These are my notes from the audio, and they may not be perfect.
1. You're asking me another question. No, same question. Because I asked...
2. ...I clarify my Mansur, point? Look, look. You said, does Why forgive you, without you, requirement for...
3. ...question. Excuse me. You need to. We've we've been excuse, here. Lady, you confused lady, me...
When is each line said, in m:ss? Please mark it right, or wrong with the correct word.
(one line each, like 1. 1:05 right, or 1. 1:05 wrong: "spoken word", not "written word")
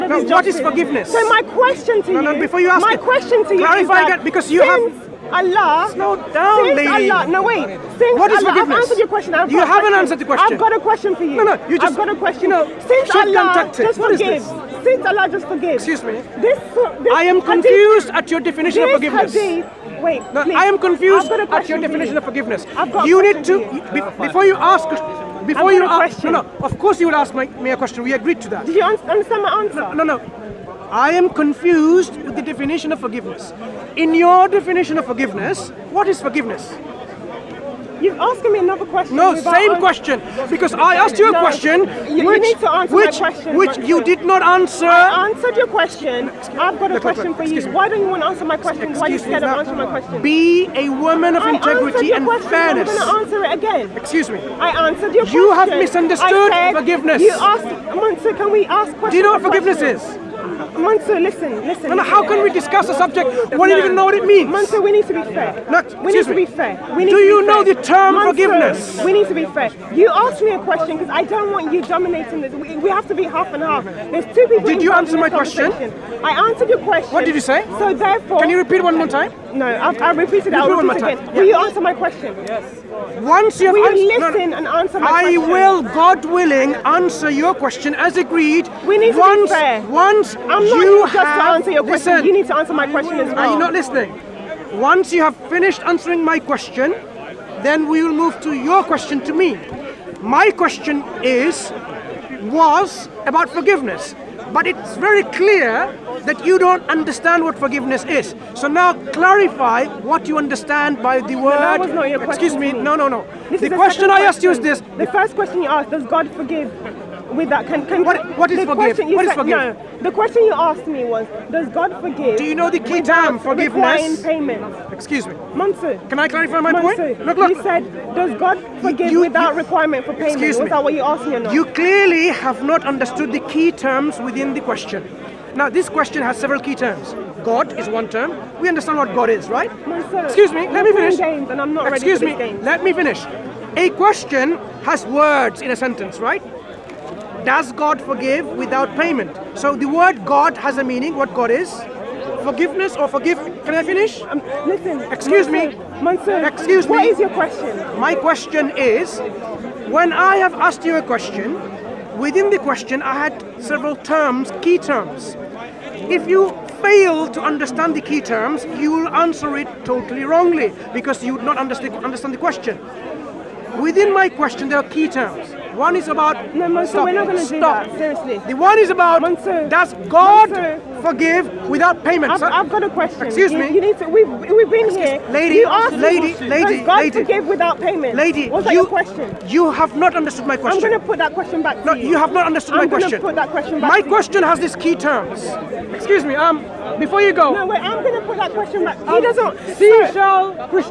1. 0:38 right
2. 2:06 wrong: "God", not "Why"
3. 3:02 wrong: "asked", not "confused".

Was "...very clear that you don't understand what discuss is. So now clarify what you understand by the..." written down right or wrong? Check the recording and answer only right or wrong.
wrong.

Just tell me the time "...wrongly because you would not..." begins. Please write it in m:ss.
2:50.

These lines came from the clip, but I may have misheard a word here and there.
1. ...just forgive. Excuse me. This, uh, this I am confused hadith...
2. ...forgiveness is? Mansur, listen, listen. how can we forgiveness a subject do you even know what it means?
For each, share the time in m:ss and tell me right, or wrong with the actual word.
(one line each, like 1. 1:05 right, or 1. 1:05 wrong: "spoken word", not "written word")
1. 0:15 right
2. 0:59 wrong: "discuss", not "forgiveness".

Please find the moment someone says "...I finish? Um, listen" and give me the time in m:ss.
2:33.